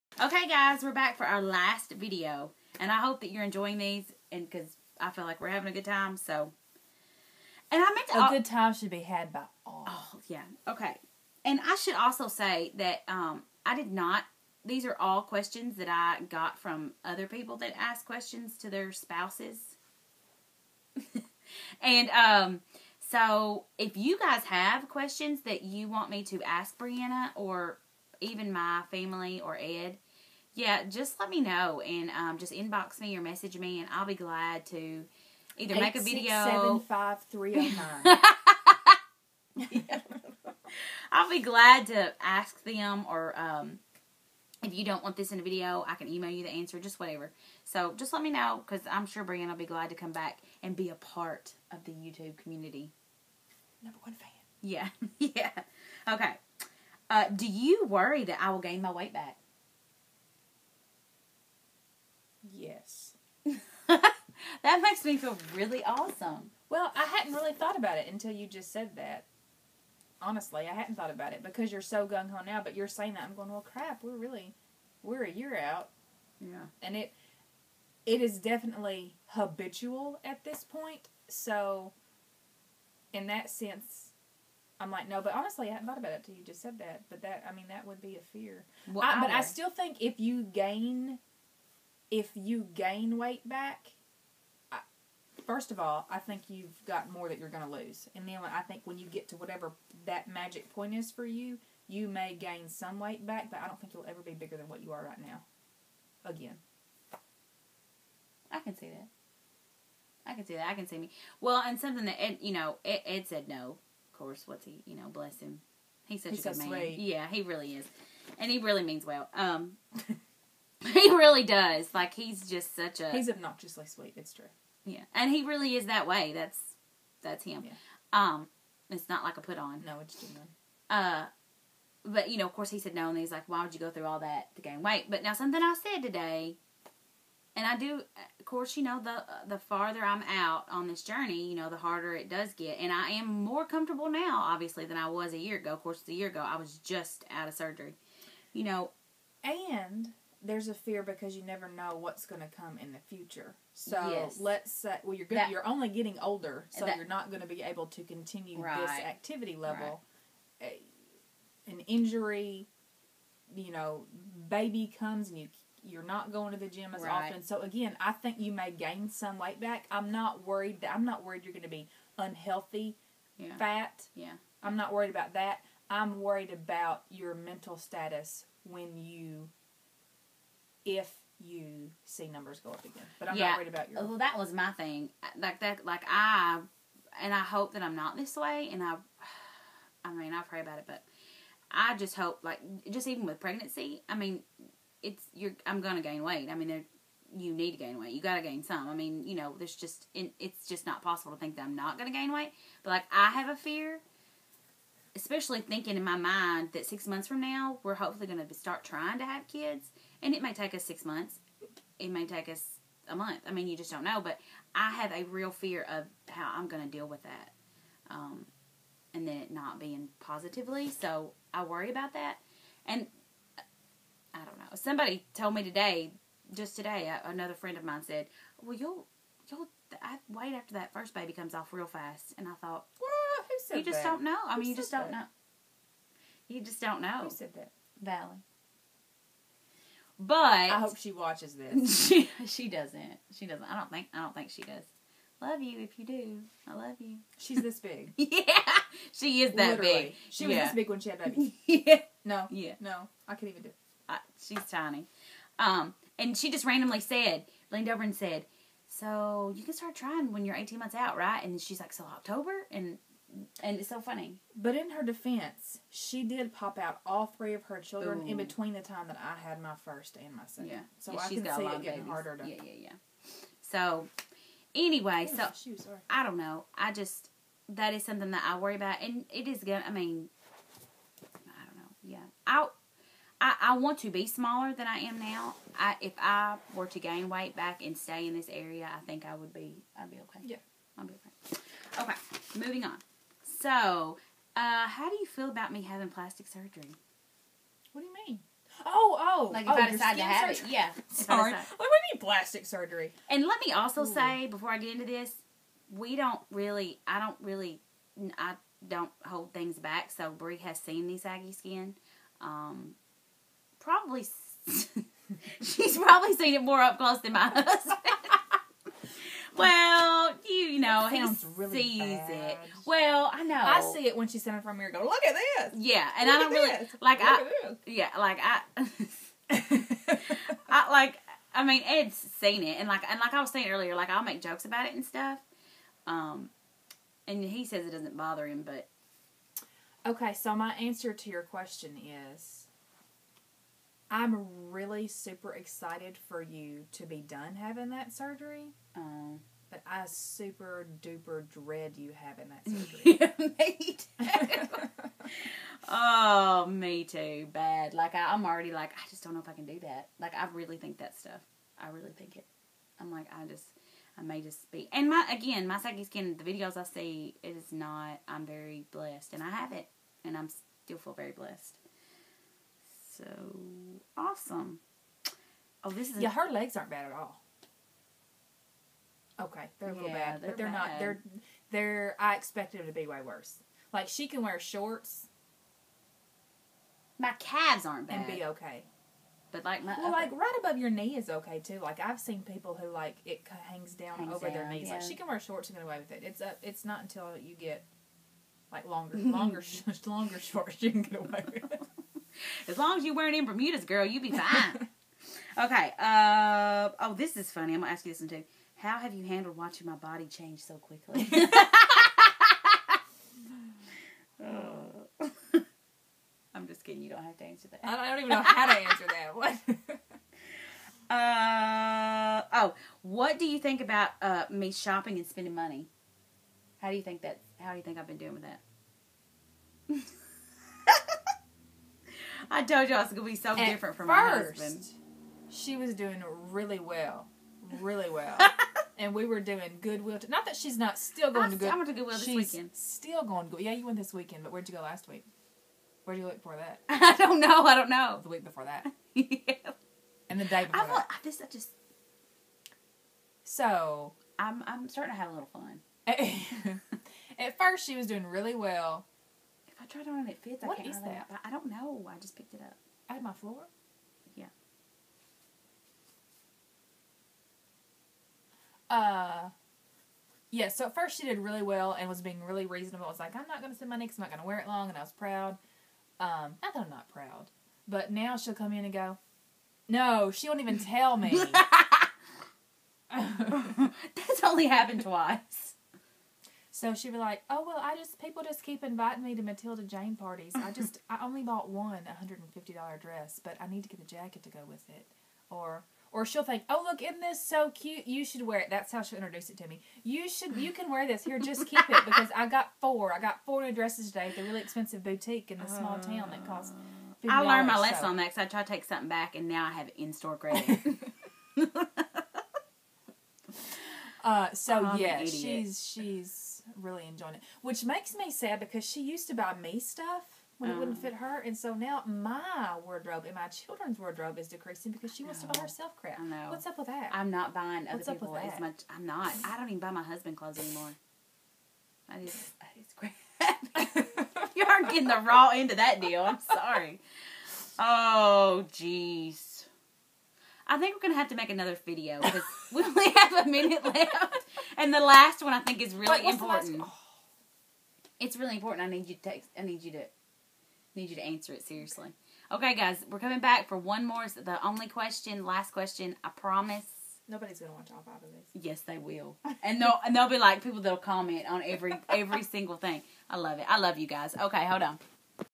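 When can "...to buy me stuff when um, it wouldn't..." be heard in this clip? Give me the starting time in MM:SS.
08:39.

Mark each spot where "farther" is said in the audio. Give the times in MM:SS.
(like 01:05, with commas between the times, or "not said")
02:19.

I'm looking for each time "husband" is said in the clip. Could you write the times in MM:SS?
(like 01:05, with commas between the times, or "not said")
05:17, 07:14, 08:50.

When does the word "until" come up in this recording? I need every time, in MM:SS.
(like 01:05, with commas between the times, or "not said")
01:08, 01:26, 06:37.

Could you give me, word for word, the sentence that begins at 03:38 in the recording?
Um, and then it not being positively.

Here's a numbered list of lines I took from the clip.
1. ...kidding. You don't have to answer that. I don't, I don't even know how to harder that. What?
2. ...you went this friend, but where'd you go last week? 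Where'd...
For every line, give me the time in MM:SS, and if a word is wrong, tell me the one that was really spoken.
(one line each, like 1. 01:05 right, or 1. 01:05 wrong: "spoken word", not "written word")
1. 06:56 wrong: "answer", not "harder"
2. 07:23 wrong: "weekend", not "friend".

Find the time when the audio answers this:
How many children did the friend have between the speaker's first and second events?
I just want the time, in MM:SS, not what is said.
04:27.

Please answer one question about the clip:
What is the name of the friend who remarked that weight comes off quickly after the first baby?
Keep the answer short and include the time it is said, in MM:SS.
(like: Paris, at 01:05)
Valley, at 03:58.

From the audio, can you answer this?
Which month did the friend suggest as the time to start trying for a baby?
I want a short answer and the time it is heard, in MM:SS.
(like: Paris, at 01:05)
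October, at 04:22.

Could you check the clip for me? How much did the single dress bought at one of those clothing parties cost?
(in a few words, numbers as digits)
$150.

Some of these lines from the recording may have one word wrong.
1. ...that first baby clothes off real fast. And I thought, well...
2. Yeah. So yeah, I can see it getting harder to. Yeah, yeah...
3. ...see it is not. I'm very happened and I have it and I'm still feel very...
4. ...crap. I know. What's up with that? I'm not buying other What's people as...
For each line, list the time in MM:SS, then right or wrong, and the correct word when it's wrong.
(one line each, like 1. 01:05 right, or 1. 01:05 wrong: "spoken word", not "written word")
1. 03:50 wrong: "comes", not "clothes"
2. 04:30 right
3. 06:06 wrong: "blessed", not "happened"
4. 08:45 right.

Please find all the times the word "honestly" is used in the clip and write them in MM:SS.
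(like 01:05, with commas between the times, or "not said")
01:10, 01:25.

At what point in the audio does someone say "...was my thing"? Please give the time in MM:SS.
03:04.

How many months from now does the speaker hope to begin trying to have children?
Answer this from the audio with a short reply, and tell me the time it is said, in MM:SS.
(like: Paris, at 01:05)
6 months, at 03:26.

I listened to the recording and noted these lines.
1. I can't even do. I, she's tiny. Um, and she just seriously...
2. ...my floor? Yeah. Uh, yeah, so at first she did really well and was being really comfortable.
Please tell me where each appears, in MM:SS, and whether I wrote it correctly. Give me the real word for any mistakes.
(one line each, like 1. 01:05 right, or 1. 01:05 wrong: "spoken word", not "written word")
1. 04:13 wrong: "randomly", not "seriously"
2. 07:43 wrong: "reasonable", not "comfortable".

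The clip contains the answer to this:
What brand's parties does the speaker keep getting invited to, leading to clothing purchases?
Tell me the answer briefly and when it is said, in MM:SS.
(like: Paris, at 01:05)
Matilda Jane, at 08:09.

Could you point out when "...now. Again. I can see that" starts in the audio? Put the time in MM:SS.
01:45.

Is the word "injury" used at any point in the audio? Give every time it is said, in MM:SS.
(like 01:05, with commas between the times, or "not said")
02:41.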